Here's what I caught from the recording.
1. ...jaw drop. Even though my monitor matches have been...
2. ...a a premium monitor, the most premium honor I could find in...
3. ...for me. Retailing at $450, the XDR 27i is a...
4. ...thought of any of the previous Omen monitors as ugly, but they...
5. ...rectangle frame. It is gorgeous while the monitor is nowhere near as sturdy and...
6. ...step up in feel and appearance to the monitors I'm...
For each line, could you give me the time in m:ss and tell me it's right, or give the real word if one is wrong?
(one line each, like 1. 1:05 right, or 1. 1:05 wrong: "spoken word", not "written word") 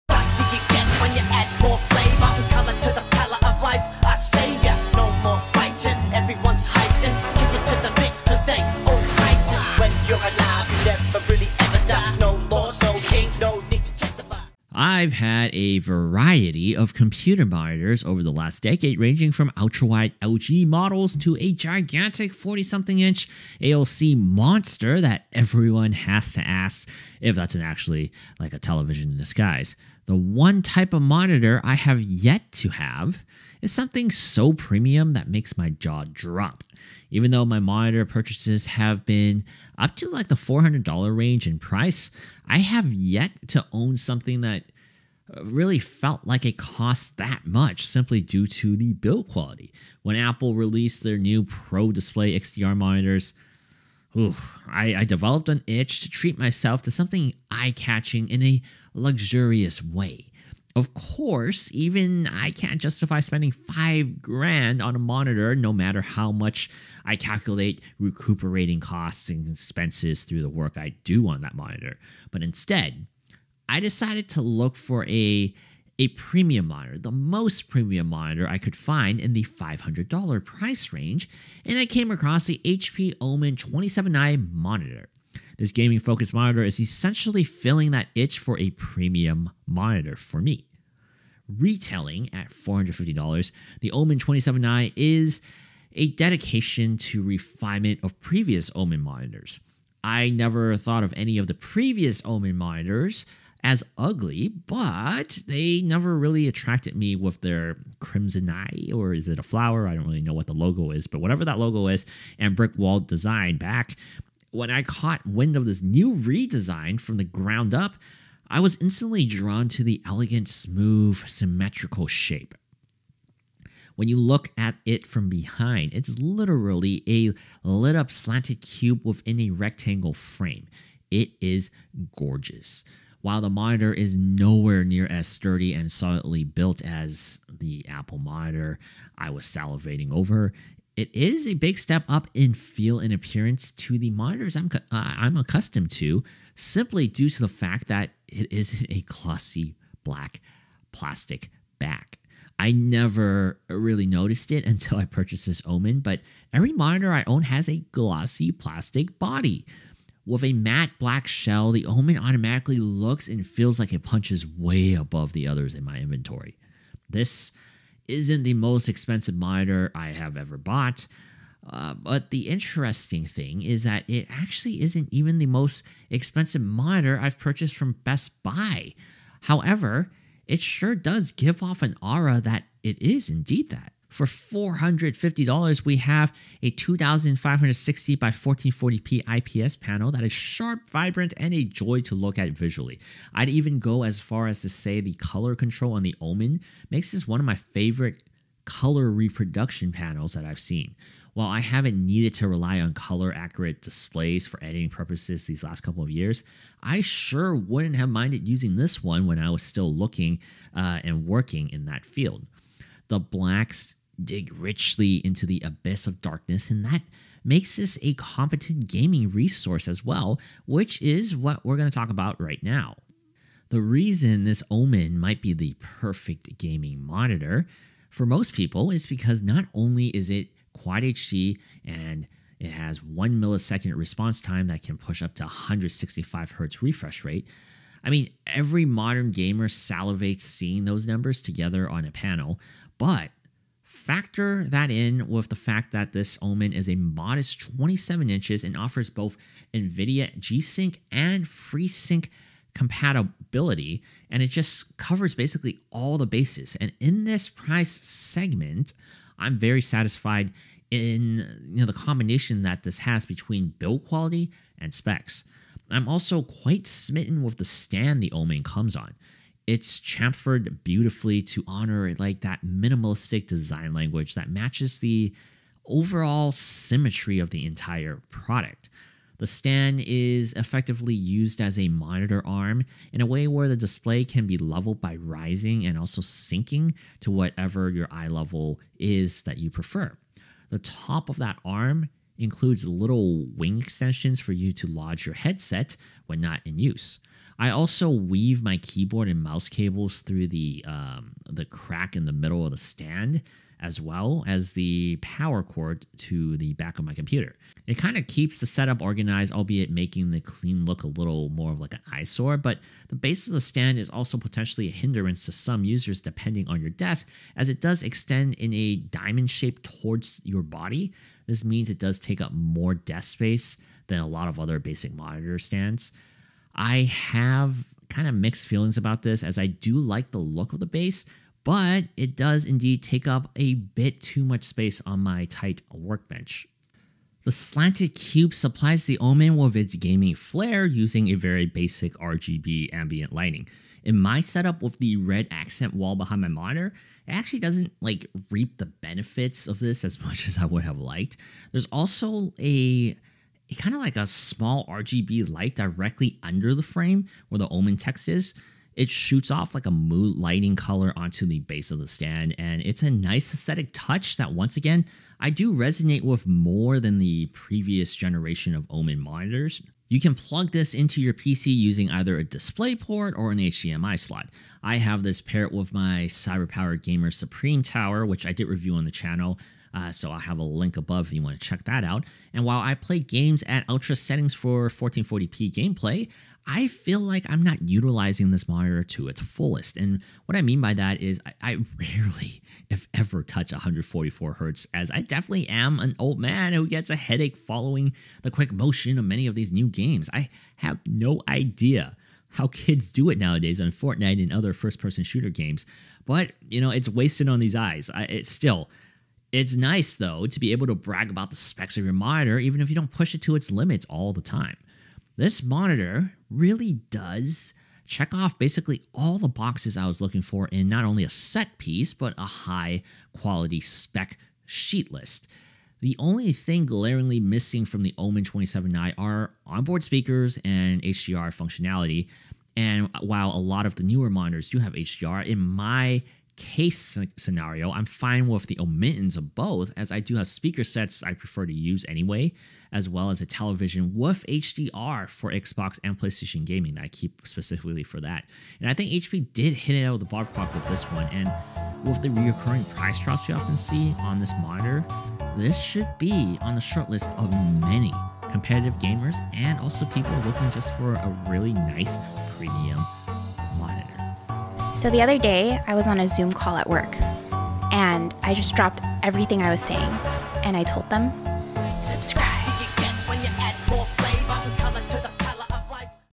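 1. 0:35 wrong: "purchases", not "matches"
2. 1:15 wrong: "monitor", not "honor"
3. 1:30 wrong: "Omen", not "XDR"
4. 1:40 right
5. 2:09 right
6. 2:21 right.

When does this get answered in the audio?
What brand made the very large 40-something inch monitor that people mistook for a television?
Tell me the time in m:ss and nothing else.
0:23.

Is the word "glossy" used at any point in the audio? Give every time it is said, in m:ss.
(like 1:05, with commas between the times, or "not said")
2:29, 2:37.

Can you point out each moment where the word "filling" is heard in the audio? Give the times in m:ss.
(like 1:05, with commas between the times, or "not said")
1:27.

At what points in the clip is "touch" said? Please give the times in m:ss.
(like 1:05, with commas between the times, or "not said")
6:03, 6:33.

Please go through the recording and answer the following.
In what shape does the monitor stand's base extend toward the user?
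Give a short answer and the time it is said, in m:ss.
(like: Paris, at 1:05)
Diamond, at 5:18.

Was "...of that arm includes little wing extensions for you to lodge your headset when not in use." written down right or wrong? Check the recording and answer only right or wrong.
right.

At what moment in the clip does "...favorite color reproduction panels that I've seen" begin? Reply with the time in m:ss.
3:17.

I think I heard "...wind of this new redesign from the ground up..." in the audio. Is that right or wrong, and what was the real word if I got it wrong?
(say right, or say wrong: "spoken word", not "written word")
right.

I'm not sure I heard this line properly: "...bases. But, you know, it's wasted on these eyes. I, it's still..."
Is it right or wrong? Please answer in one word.
wrong.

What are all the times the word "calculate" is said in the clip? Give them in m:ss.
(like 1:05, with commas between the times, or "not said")
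1:07.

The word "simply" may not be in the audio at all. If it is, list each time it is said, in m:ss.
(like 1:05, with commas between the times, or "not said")
0:47, 2:26.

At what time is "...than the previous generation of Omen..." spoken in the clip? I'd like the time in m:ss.
6:06.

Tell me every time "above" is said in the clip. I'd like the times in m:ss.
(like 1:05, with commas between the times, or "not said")
2:44, 6:20.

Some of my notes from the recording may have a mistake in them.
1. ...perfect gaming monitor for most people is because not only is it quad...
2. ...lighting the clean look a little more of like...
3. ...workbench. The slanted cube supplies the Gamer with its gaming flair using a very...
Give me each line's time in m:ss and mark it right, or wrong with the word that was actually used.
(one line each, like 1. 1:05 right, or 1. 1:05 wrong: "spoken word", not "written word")
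1. 3:45 right
2. 5:09 wrong: "making", not "lighting"
3. 5:35 wrong: "Omen", not "Gamer".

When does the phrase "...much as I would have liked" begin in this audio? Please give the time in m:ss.
5:50.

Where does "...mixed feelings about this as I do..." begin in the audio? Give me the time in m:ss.
5:28.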